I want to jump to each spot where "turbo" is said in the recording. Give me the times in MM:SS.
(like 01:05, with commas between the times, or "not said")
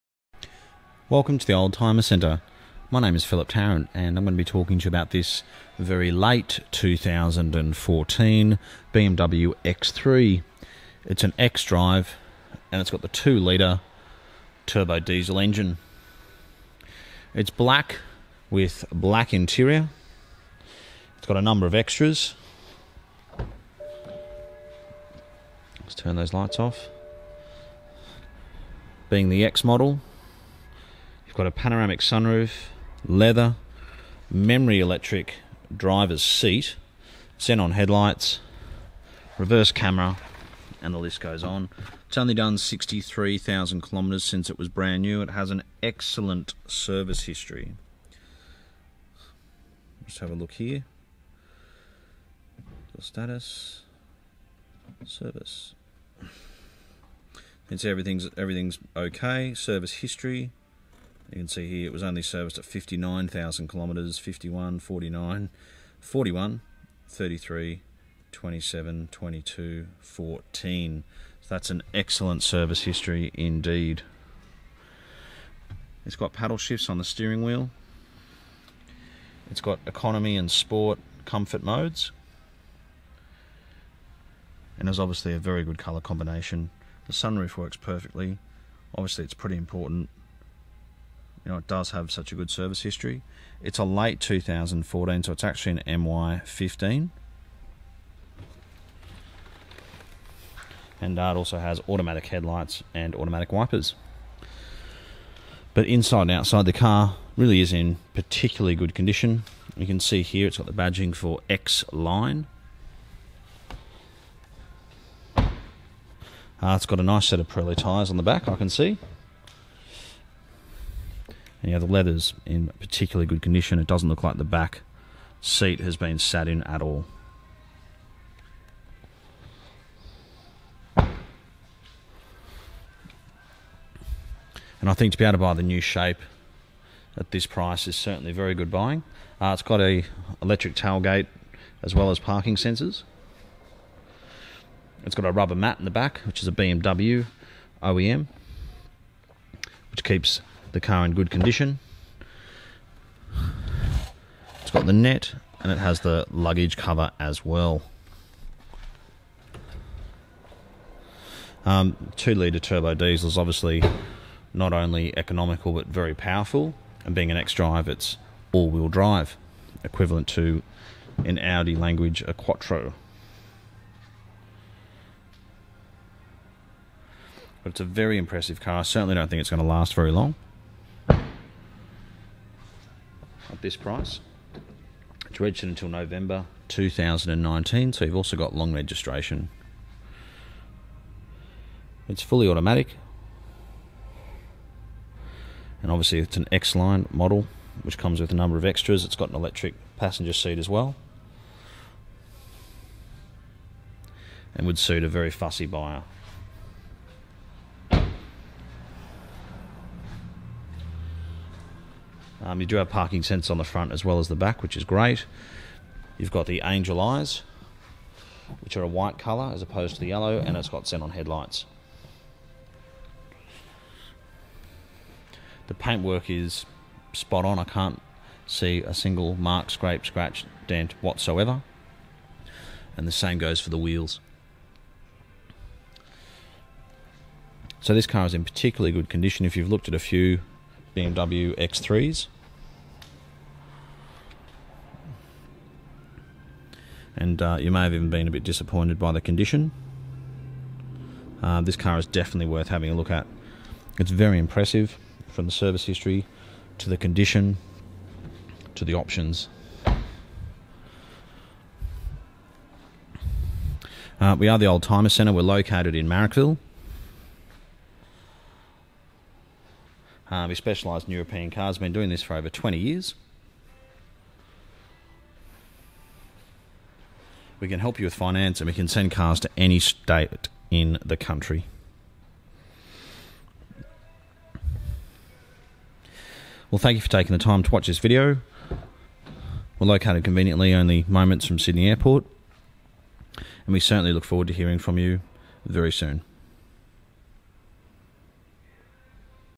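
00:14, 02:42.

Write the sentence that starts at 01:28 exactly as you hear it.
Obviously it's pretty important you know, it does have such a good service history.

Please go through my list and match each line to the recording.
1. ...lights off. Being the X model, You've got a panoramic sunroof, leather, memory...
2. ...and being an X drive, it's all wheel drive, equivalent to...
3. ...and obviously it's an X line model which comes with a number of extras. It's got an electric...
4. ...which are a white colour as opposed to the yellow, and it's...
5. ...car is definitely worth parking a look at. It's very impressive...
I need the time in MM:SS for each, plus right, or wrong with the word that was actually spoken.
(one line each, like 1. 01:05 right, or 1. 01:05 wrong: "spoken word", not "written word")
1. 00:26 right
2. 02:47 right
3. 03:15 right
4. 03:38 right
5. 04:11 wrong: "having", not "parking".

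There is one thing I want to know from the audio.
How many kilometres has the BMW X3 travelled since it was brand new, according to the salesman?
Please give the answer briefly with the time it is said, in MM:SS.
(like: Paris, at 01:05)
63,000 kilometres, at 00:42.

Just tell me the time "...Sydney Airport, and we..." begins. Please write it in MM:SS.
04:51.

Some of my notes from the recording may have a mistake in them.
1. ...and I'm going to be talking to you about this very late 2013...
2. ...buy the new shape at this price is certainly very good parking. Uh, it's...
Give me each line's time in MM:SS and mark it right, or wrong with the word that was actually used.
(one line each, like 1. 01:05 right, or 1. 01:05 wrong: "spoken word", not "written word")
1. 00:03 wrong: "2014", not "2013"
2. 02:15 wrong: "buying", not "parking".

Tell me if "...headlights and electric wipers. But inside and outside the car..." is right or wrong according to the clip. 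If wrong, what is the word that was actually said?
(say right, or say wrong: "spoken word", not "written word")
wrong: "automatic", not "electric".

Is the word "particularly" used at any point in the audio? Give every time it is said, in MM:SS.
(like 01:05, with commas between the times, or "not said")
01:48, 02:02, 03:58.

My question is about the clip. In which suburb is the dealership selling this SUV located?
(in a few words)
Marrickville.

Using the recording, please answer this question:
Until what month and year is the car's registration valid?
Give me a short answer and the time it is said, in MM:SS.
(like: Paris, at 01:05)
November 2019, at 03:05.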